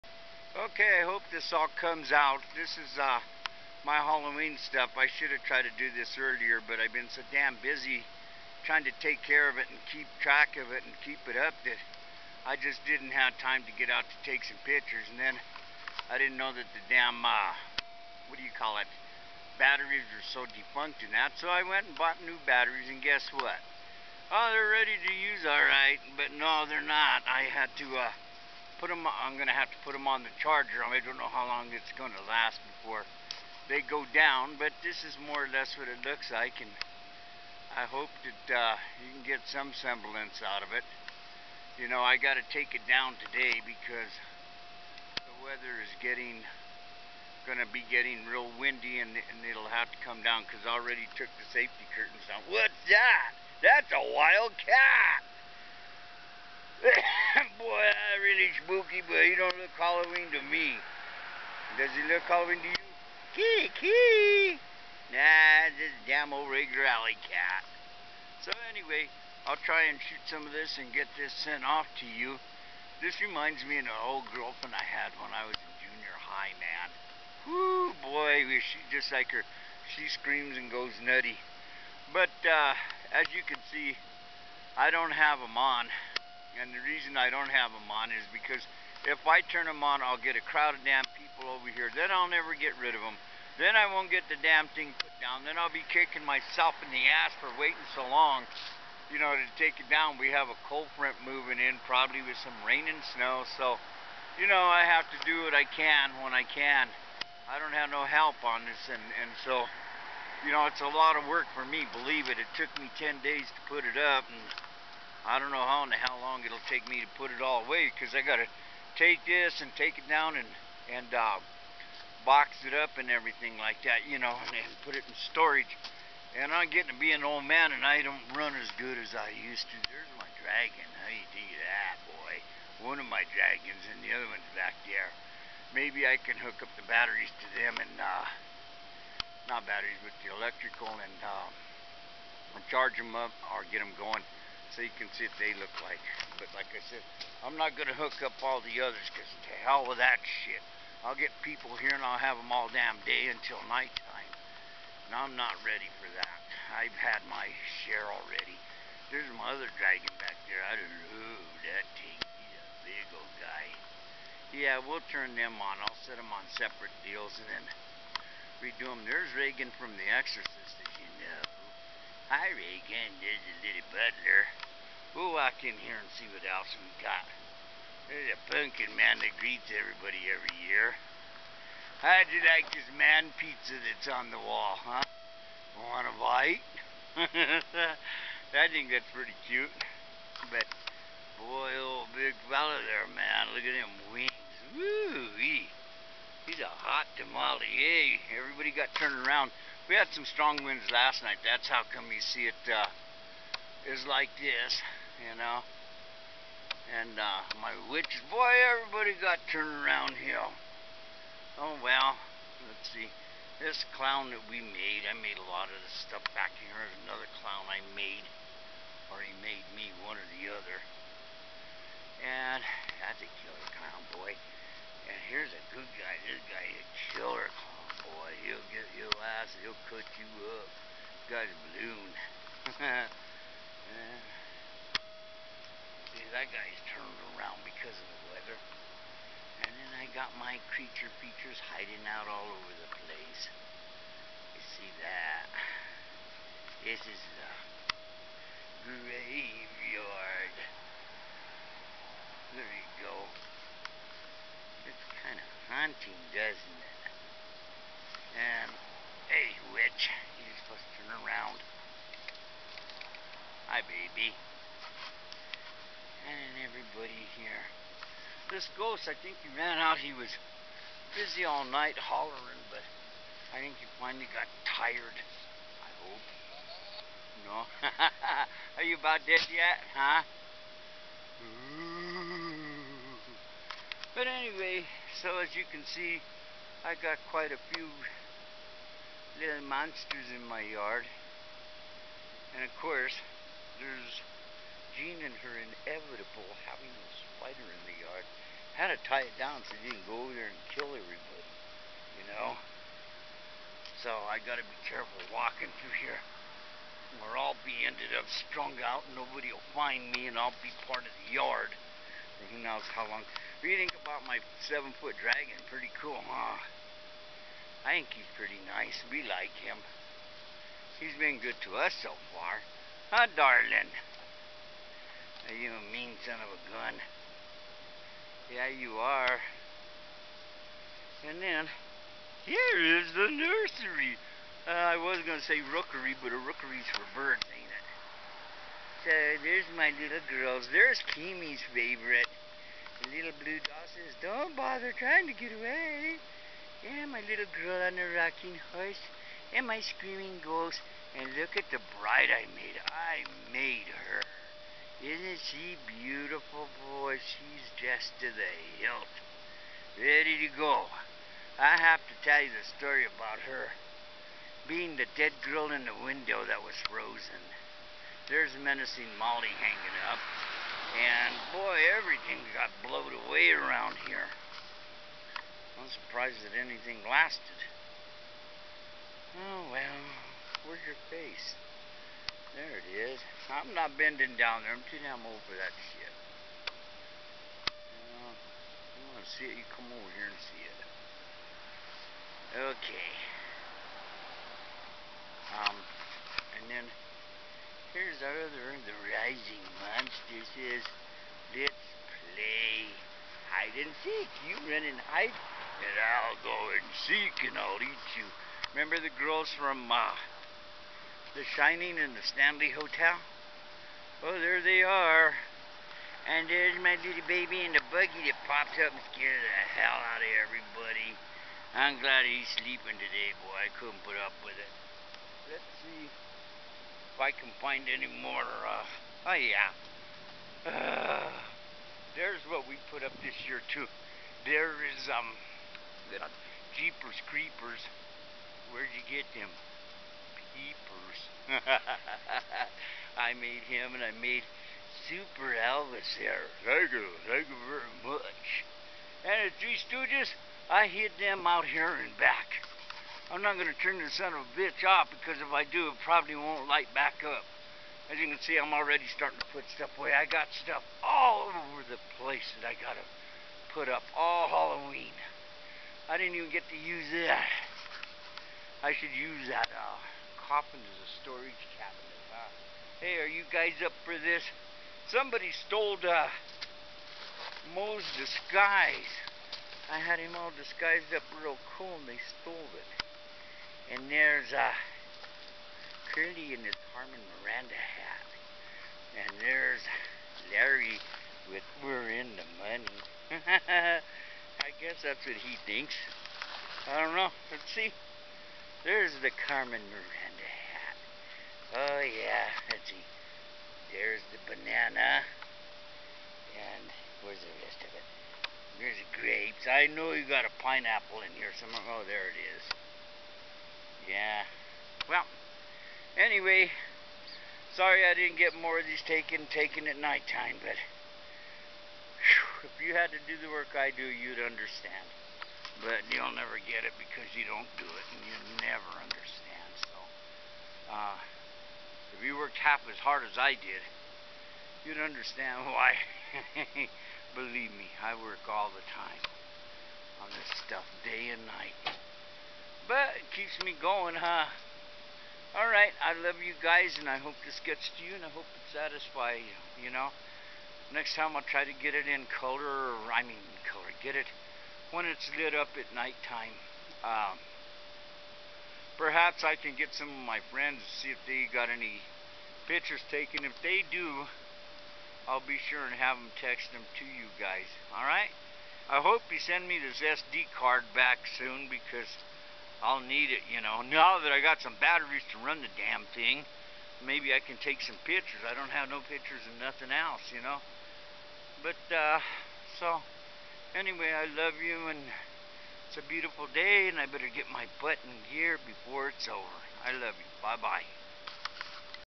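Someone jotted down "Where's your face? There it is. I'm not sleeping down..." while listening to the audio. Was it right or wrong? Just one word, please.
wrong.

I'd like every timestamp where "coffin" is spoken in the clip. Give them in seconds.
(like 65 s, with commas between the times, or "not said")
470 s.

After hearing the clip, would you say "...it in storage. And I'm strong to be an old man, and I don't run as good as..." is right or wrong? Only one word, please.
wrong.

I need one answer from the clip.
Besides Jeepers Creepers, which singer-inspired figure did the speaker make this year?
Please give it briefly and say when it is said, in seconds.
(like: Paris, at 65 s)
Super Elvis, at 445 s.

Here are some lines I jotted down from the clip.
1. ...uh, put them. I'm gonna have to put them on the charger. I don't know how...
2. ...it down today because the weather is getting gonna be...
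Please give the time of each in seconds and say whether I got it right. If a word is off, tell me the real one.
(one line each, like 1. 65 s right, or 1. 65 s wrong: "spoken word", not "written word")
1. 27 s right
2. 42 s right.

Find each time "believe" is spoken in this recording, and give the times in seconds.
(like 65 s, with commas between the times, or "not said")
111 s, 537 s.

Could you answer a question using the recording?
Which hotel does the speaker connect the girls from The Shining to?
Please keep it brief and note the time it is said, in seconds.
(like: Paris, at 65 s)
Stanley Hotel, at 412 s.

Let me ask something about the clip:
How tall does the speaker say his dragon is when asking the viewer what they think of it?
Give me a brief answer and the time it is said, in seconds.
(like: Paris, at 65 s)
7 feet, at 314 s.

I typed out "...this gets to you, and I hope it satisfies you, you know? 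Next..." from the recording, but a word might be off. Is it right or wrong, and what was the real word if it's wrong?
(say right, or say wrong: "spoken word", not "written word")
right.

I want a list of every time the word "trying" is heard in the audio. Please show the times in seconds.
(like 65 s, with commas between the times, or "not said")
8 s, 344 s.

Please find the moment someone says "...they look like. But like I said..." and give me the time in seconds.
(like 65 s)
145 s.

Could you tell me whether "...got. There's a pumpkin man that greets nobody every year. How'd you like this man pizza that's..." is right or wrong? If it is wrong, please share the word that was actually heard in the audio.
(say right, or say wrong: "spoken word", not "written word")
wrong: "everybody", not "nobody".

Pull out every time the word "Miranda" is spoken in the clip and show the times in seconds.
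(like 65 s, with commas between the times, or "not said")
487 s, 499 s.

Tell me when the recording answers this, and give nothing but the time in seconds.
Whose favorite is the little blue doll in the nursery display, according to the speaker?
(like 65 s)
341 s.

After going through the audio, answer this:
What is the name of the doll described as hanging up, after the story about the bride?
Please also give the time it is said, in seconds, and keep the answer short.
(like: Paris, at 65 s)
Menacing Molly, at 368 s.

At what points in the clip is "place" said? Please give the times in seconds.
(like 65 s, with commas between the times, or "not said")
243 s, 462 s.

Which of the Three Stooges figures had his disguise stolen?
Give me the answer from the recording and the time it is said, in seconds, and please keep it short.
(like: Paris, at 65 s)
Moe, at 477 s.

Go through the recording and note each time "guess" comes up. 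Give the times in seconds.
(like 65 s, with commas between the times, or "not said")
22 s, 494 s.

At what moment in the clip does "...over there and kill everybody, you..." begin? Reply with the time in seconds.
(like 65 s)
300 s.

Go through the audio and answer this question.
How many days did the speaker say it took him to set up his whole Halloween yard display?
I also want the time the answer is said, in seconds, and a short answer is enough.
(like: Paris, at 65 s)
10, at 112 s.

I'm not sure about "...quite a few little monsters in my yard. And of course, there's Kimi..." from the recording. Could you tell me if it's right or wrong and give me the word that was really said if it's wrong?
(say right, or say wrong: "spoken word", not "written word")
wrong: "Jean", not "Kimi".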